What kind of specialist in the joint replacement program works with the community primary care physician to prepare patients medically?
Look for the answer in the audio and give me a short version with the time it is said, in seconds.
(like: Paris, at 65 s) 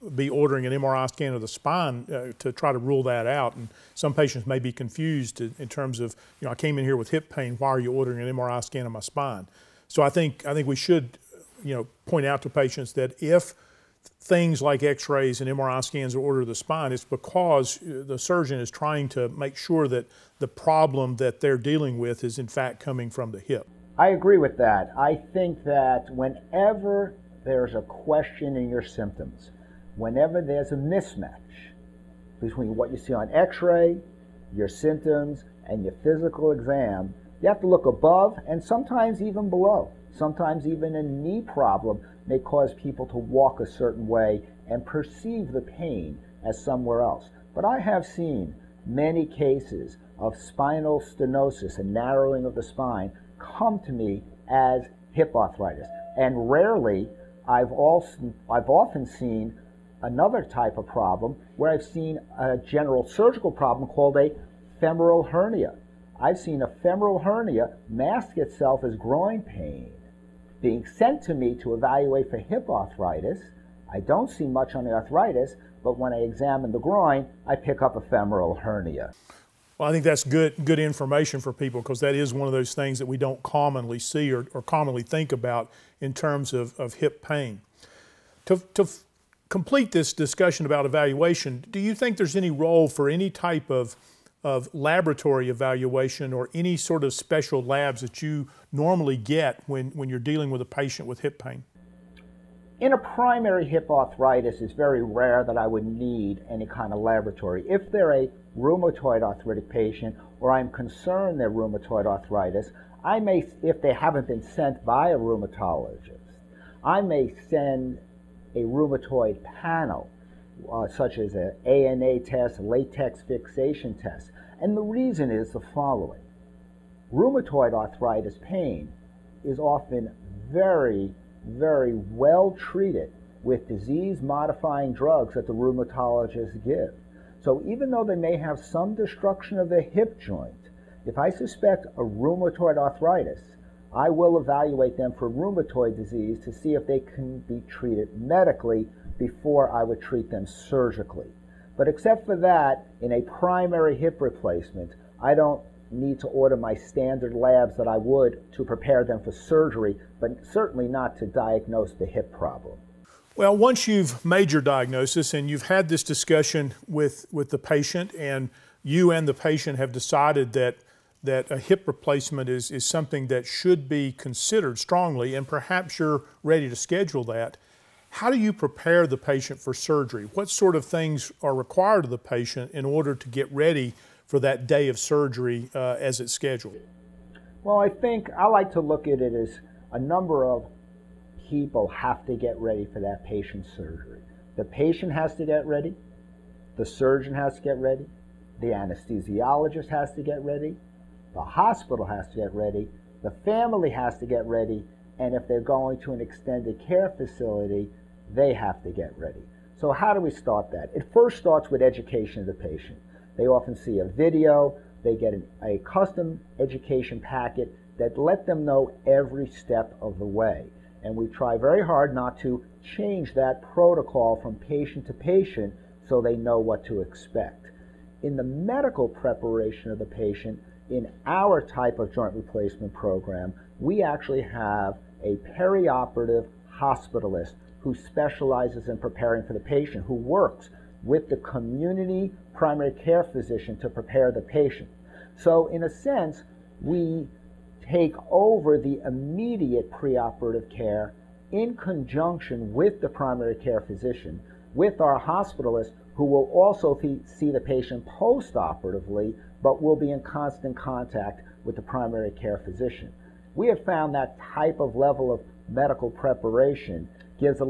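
perioperative hospitalist, at 235 s.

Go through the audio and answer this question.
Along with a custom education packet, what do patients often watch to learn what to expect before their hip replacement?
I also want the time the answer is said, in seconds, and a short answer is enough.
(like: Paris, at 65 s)
a video, at 214 s.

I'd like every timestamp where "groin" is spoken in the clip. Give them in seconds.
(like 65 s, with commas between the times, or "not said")
68 s, 76 s.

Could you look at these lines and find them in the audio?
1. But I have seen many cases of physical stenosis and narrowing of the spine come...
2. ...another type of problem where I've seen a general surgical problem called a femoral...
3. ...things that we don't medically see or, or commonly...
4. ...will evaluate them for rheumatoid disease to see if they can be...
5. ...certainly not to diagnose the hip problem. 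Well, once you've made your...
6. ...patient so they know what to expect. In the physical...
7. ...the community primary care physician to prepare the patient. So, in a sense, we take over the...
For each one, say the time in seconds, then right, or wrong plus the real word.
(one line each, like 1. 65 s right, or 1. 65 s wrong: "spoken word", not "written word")
1. 47 s wrong: "spinal", not "physical"
2. 60 s right
3. 82 s wrong: "commonly", not "medically"
4. 144 s right
5. 160 s right
6. 225 s wrong: "medical", not "physical"
7. 241 s right.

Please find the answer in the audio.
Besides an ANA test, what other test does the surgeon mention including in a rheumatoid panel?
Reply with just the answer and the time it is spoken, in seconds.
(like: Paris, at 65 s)
latex fixation test, at 122 s.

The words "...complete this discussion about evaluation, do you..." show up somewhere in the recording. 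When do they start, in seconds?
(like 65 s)
89 s.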